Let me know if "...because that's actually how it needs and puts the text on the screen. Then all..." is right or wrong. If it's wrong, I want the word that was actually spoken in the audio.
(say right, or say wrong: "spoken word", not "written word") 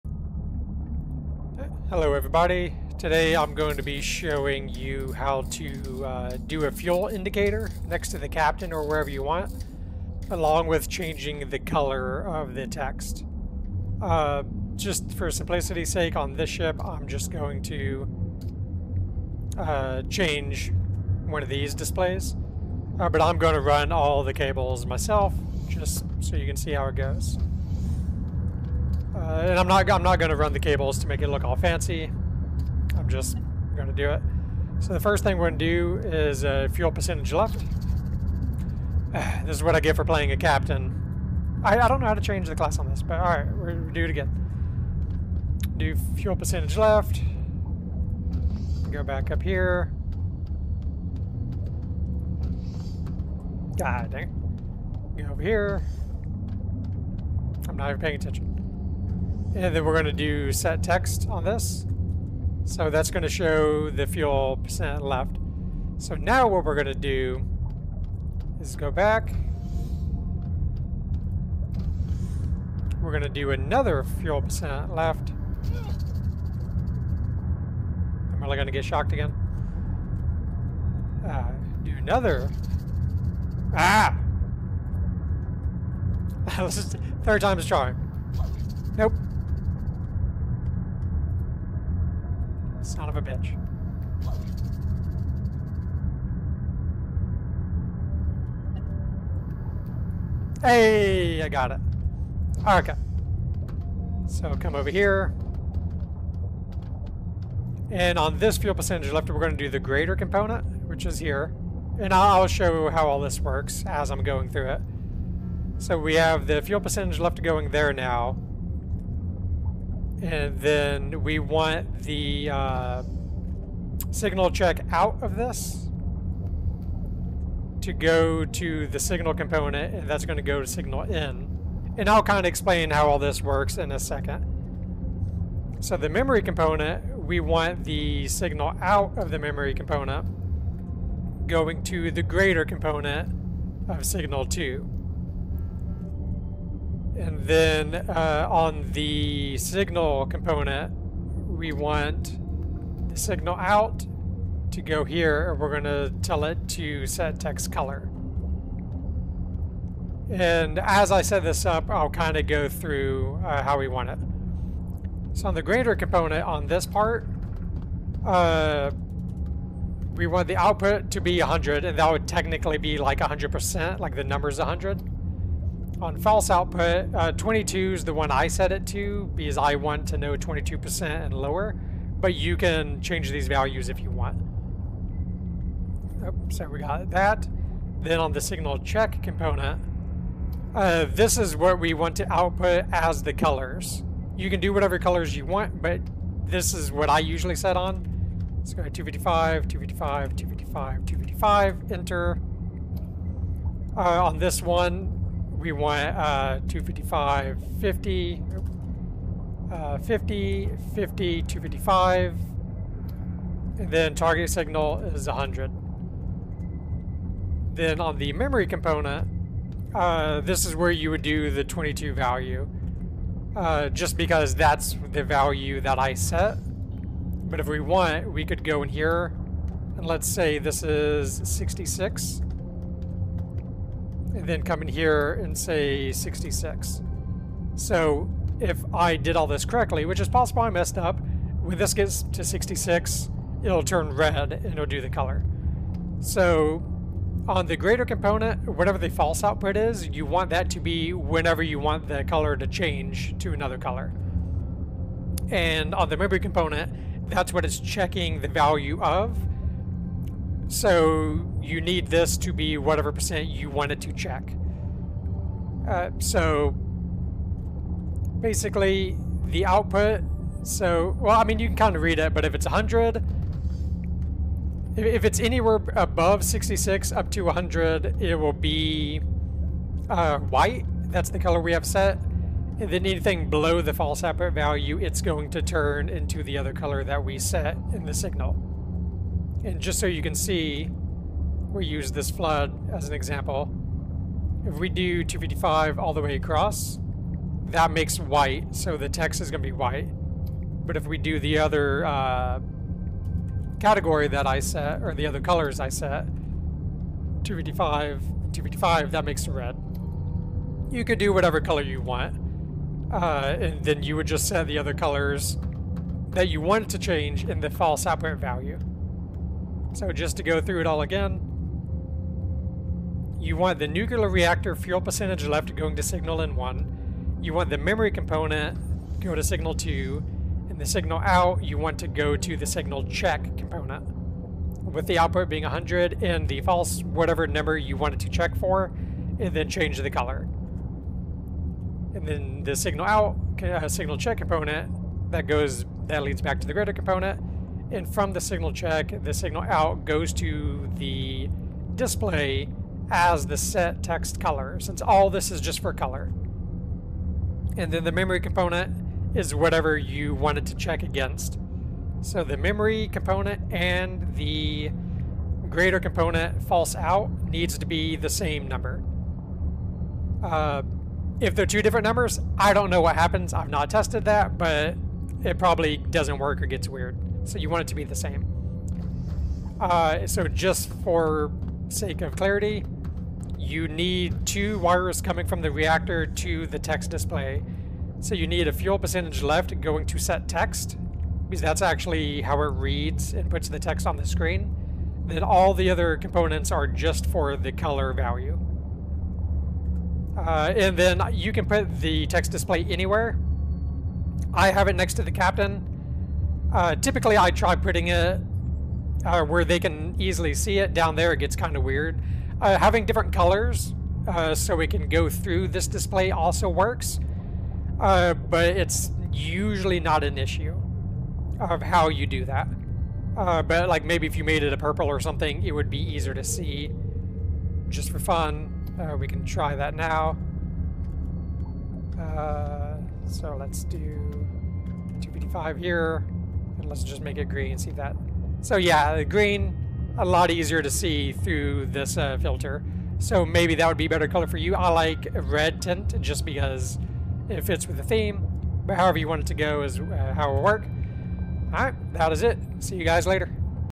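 wrong: "reads", not "needs".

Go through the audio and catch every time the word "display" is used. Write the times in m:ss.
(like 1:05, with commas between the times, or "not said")
0:21, 5:51, 6:27, 6:42, 6:55.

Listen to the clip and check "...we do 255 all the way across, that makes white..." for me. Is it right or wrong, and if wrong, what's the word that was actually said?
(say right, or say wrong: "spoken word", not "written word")
right.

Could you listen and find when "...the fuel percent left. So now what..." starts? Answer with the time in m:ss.
1:03.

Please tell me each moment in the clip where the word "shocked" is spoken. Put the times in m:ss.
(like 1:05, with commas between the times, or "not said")
1:18.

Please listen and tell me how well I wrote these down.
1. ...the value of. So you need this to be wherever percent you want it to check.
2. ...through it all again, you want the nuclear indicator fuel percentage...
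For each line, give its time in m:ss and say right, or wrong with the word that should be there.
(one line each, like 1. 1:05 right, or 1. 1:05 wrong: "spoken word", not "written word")
1. 4:18 wrong: "whatever", not "wherever"
2. 5:20 wrong: "reactor", not "indicator".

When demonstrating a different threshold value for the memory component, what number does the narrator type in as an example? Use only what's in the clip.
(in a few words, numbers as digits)
66.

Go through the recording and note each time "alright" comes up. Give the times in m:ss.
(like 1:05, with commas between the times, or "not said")
0:43, 7:31.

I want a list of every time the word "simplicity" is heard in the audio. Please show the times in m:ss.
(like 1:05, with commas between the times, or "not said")
0:15.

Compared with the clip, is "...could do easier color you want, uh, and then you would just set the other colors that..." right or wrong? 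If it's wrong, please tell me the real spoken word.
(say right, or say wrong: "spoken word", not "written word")
wrong: "whatever", not "easier".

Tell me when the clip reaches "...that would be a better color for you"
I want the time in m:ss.
7:23.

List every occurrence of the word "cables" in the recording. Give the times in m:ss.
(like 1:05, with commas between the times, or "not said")
0:24, 0:30.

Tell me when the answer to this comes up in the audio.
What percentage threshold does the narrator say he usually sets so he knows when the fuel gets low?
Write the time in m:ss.
2:57.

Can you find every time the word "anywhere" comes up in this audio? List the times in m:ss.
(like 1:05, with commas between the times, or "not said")
4:35, 6:42.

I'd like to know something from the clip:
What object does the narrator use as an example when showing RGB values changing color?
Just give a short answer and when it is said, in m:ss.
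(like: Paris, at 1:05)
flood, at 4:51.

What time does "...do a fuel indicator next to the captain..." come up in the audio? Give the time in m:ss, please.
0:06.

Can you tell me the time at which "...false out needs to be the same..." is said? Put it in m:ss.
6:06.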